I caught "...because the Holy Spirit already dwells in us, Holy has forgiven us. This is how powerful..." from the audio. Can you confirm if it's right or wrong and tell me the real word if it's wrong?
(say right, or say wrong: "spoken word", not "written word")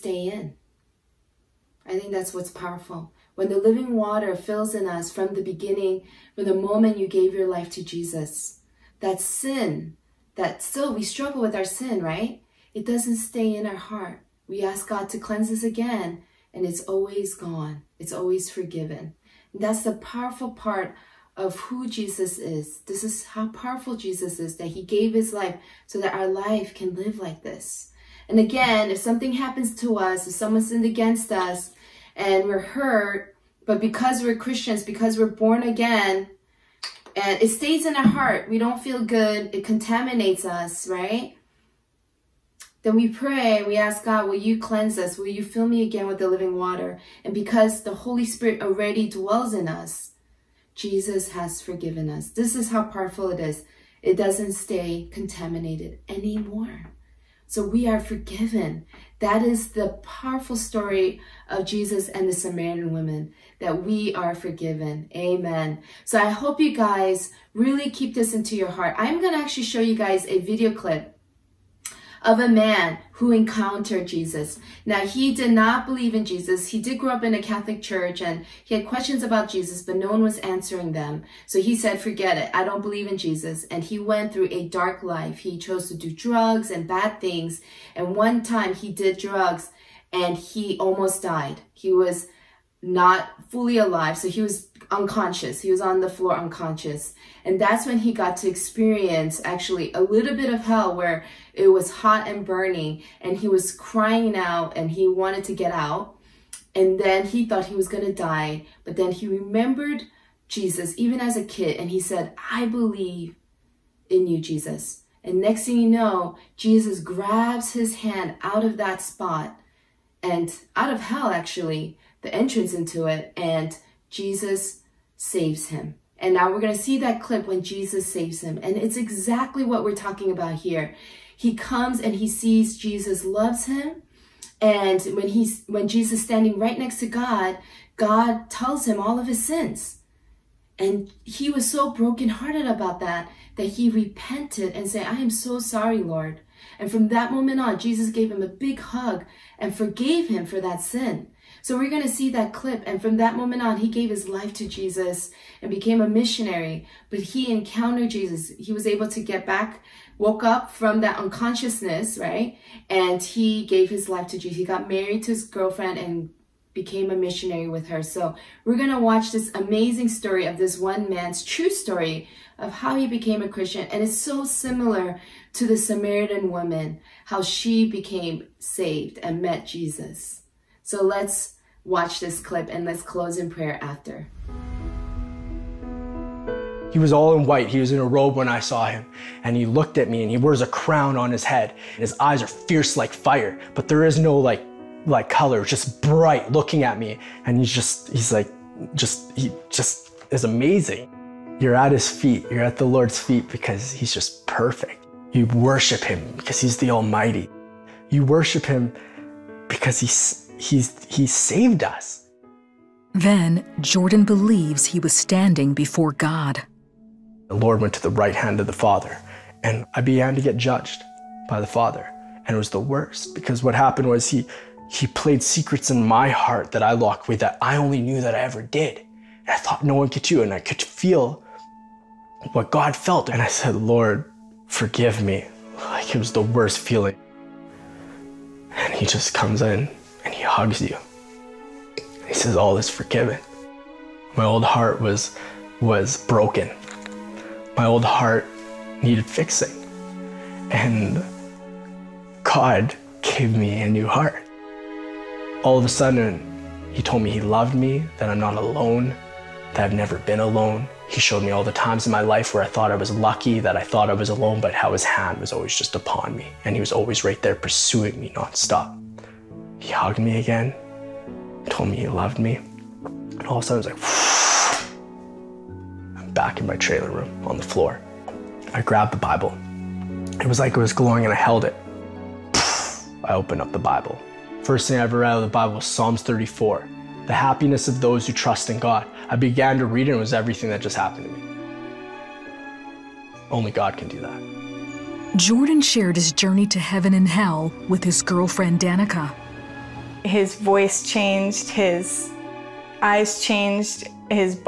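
wrong: "Jesus", not "Holy".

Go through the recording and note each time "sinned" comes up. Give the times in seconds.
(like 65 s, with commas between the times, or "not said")
30 s.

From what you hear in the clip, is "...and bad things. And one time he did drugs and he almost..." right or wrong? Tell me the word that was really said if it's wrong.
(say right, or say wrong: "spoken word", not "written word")
right.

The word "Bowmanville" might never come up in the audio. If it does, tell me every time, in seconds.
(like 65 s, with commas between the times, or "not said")
not said.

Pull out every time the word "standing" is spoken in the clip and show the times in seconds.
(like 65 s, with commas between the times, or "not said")
136 s, 215 s.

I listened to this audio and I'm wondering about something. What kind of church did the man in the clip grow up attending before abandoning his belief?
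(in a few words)
Catholic.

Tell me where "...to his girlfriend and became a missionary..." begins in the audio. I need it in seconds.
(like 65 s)
165 s.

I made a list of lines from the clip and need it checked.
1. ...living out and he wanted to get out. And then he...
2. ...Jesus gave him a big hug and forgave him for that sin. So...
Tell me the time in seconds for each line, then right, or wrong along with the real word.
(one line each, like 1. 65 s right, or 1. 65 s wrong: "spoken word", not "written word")
1. 103 s wrong: "crying", not "living"
2. 147 s right.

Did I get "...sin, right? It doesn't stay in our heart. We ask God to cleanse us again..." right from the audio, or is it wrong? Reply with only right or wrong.
right.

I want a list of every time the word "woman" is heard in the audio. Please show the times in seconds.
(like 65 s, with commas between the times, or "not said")
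62 s, 176 s.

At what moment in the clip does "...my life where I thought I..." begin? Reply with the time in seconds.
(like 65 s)
262 s.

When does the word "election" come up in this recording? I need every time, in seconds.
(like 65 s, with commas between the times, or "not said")
not said.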